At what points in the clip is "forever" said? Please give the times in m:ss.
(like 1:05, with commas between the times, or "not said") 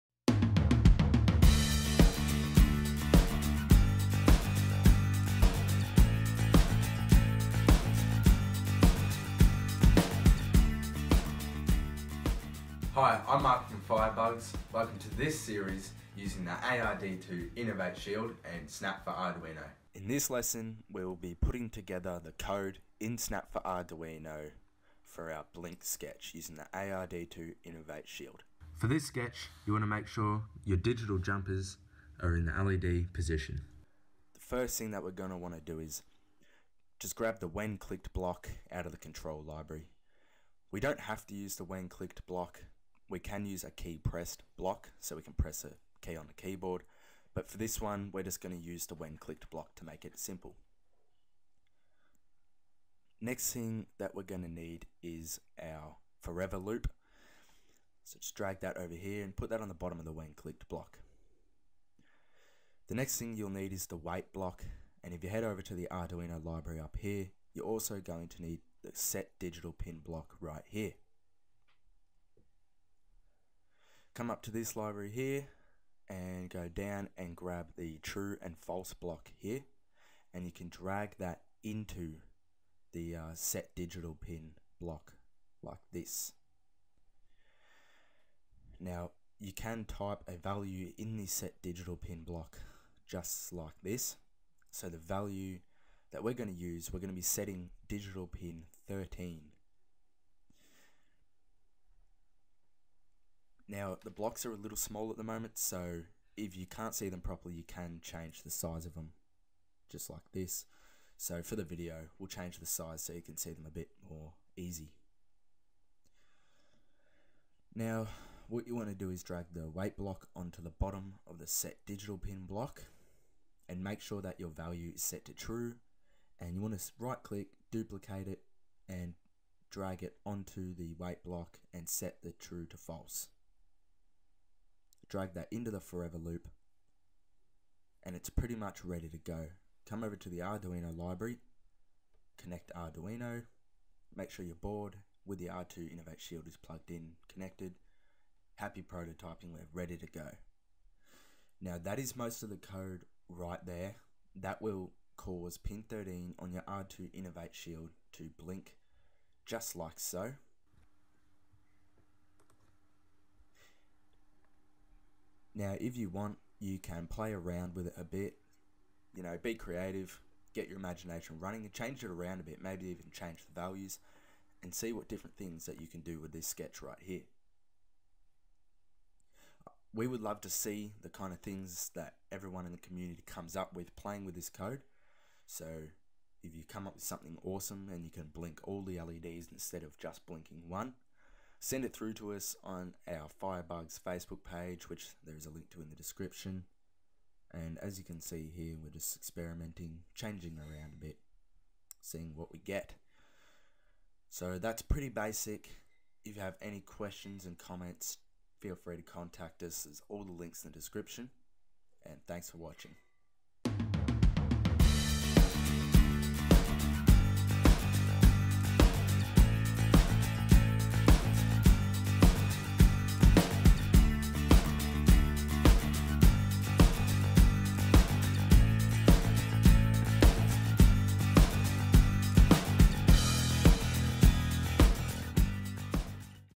0:56, 2:15.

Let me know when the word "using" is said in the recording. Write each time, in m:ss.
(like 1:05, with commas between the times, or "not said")
0:16, 0:26.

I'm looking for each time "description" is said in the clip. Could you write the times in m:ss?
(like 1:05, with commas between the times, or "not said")
3:15, 3:30.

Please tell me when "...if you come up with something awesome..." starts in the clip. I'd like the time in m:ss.
3:06.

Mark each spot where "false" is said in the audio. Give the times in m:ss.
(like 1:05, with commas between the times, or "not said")
1:18, 2:12.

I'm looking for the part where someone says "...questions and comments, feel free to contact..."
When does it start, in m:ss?
3:26.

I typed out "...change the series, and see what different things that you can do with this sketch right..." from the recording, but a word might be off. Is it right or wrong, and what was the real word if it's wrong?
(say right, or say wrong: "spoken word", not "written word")
wrong: "values", not "series".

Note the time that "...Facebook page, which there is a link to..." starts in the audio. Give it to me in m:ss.
3:13.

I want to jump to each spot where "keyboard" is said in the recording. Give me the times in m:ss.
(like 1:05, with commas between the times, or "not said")
0:46.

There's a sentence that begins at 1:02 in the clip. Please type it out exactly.
The next thing you'll need is the wait block.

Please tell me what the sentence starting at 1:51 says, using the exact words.
So for the video, we'll change the size so you can see them a bit more easy.